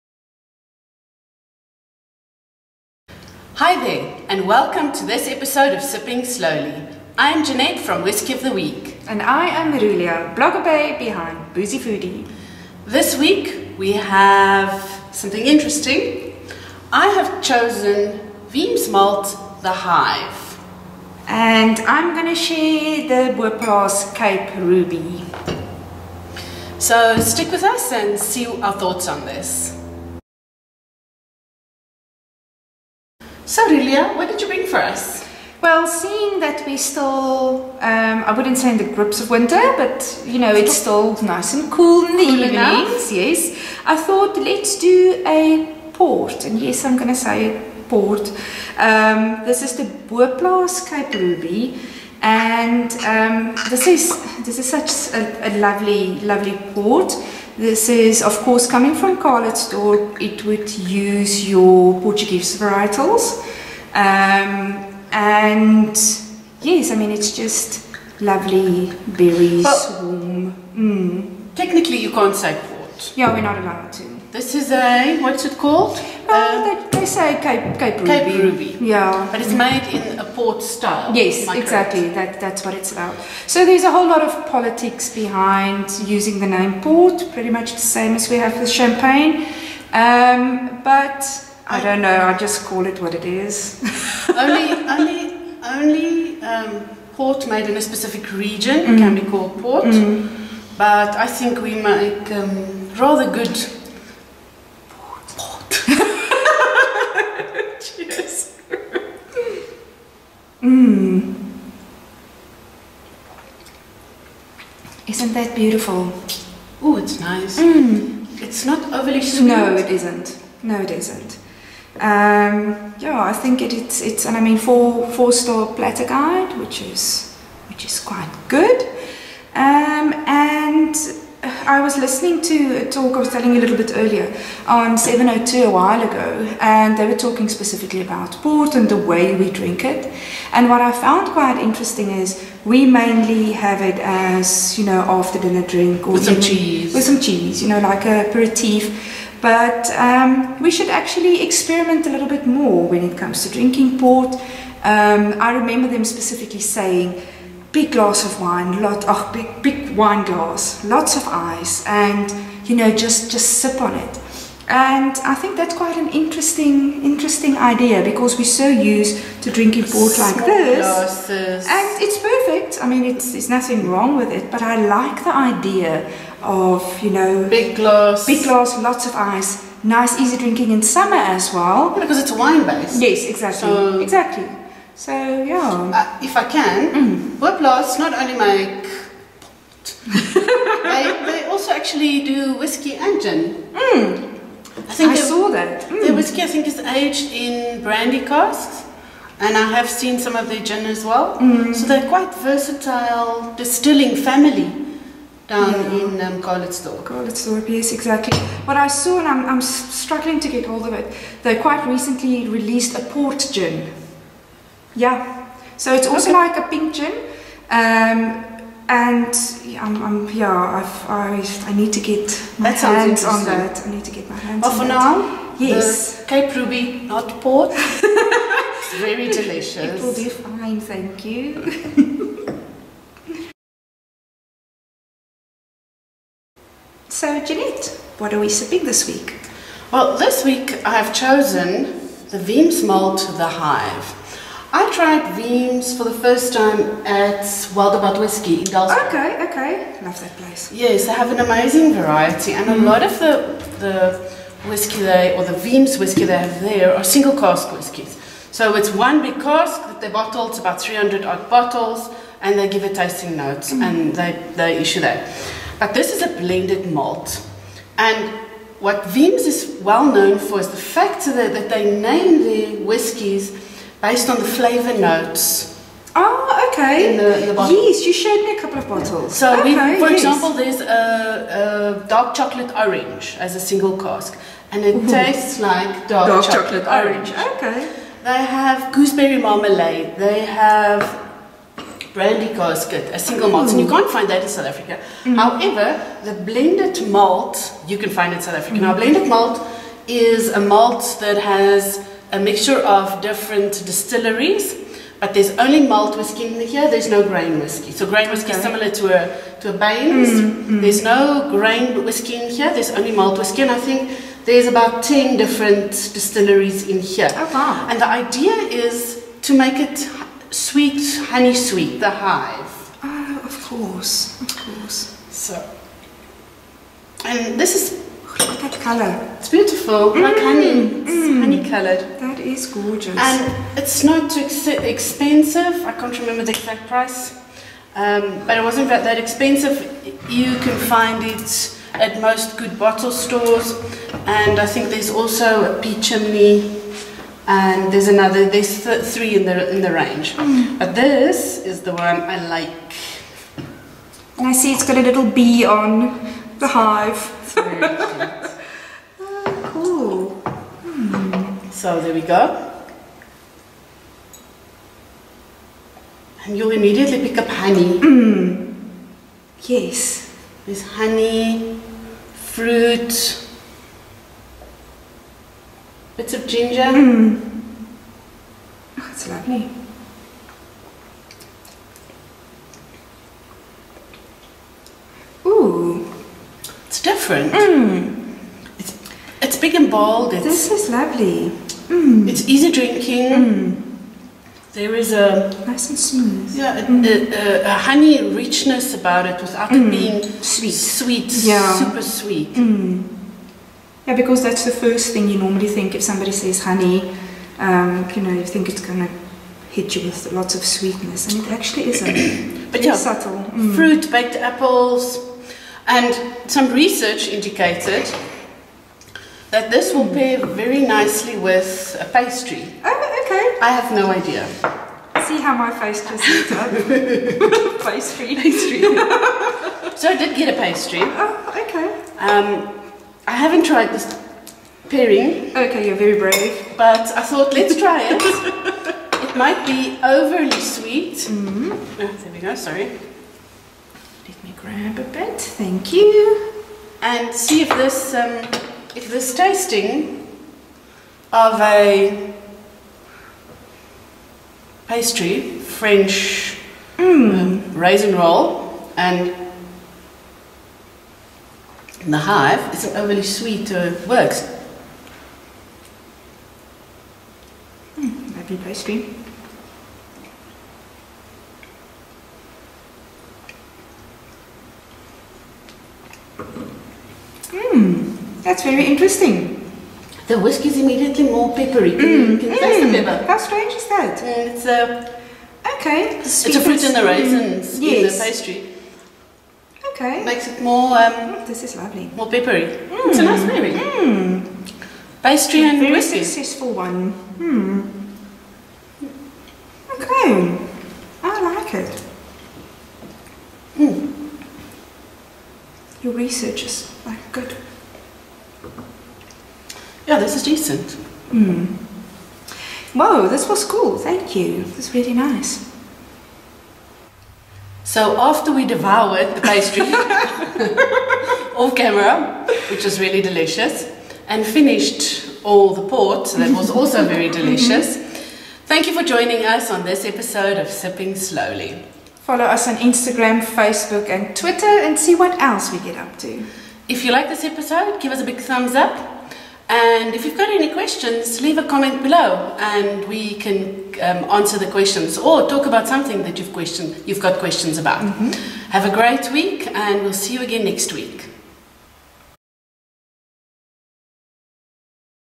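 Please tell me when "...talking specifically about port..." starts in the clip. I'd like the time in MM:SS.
02:17.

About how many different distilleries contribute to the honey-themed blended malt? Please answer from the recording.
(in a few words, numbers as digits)
10.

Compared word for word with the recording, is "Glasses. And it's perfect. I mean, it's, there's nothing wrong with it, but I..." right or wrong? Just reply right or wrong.
right.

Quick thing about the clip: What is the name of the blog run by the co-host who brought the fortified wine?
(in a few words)
Boozy Foodie.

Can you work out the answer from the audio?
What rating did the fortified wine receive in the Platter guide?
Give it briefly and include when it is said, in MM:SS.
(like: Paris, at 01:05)
4 stars, at 02:05.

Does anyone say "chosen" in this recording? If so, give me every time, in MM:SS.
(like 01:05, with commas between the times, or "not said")
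00:17, 04:01.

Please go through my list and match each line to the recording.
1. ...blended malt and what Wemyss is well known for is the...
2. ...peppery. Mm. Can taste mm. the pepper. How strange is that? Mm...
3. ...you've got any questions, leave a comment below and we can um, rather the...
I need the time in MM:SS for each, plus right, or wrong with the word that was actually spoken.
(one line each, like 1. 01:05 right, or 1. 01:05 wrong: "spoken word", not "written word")
1. 04:26 right
2. 08:01 right
3. 09:00 wrong: "answer", not "rather".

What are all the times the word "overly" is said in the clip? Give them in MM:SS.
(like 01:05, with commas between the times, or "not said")
01:58, 07:20, 07:42.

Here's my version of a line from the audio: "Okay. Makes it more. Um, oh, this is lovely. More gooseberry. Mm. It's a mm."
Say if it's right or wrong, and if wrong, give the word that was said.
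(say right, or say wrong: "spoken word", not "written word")
wrong: "peppery", not "gooseberry".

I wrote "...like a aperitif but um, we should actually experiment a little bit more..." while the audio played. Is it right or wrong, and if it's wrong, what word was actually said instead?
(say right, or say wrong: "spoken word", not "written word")
right.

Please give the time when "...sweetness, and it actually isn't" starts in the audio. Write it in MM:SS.
06:50.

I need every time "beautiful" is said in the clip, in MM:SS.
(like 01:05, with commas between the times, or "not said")
01:55, 05:29.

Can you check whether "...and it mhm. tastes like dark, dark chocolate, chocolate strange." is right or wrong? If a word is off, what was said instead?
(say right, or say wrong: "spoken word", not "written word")
wrong: "orange", not "strange".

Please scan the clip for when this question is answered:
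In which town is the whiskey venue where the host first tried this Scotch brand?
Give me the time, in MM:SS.
04:08.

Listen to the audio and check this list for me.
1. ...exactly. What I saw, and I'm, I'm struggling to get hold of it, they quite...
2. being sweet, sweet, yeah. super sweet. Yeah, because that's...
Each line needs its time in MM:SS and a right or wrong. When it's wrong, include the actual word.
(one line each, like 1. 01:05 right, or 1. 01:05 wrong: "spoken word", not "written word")
1. 03:27 right
2. 06:39 right.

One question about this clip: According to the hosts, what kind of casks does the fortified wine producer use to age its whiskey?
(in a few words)
Brandy casks.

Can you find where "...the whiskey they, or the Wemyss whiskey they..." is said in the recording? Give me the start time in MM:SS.
04:13.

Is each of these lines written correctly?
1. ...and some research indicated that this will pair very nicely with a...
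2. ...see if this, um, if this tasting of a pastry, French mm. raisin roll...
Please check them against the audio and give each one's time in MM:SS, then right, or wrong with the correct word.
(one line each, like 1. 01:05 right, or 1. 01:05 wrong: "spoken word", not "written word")
1. 06:55 right
2. 07:27 right.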